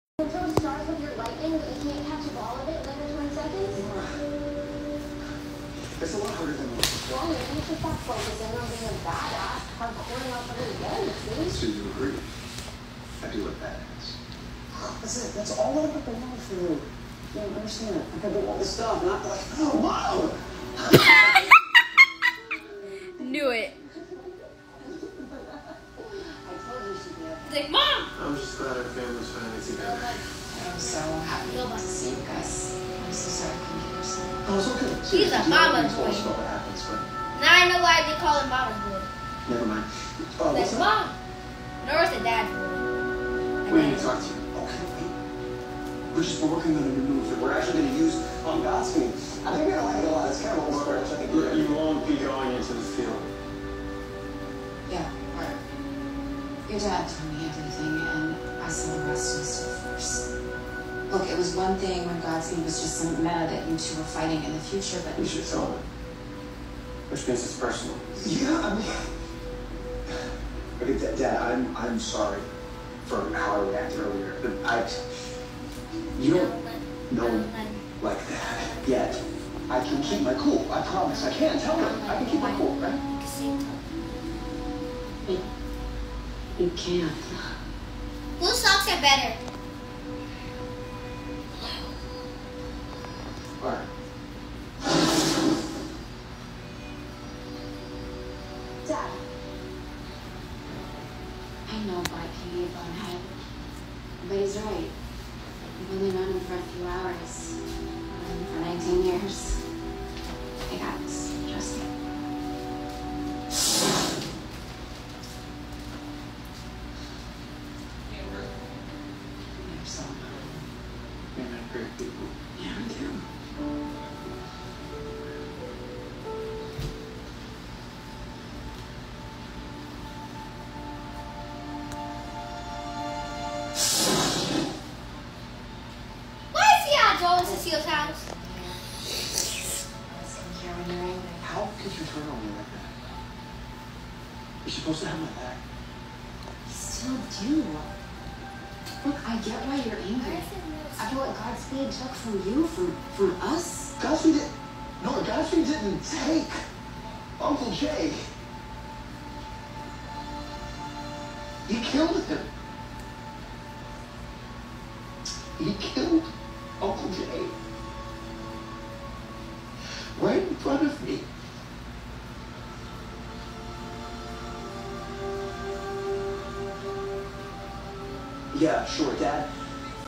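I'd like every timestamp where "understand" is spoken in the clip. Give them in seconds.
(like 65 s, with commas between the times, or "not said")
17 s.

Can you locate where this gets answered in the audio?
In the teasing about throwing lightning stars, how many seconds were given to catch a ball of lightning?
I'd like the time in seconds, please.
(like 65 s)
3 s.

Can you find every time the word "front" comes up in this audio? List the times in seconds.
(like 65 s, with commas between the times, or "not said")
170 s.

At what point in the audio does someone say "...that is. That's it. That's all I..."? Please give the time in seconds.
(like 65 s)
13 s.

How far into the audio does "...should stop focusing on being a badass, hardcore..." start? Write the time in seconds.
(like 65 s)
7 s.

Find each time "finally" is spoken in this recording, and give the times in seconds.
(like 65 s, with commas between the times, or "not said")
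29 s.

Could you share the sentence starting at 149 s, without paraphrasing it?
Look, I get why you're angry.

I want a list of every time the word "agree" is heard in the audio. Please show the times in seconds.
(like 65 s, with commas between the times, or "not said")
11 s.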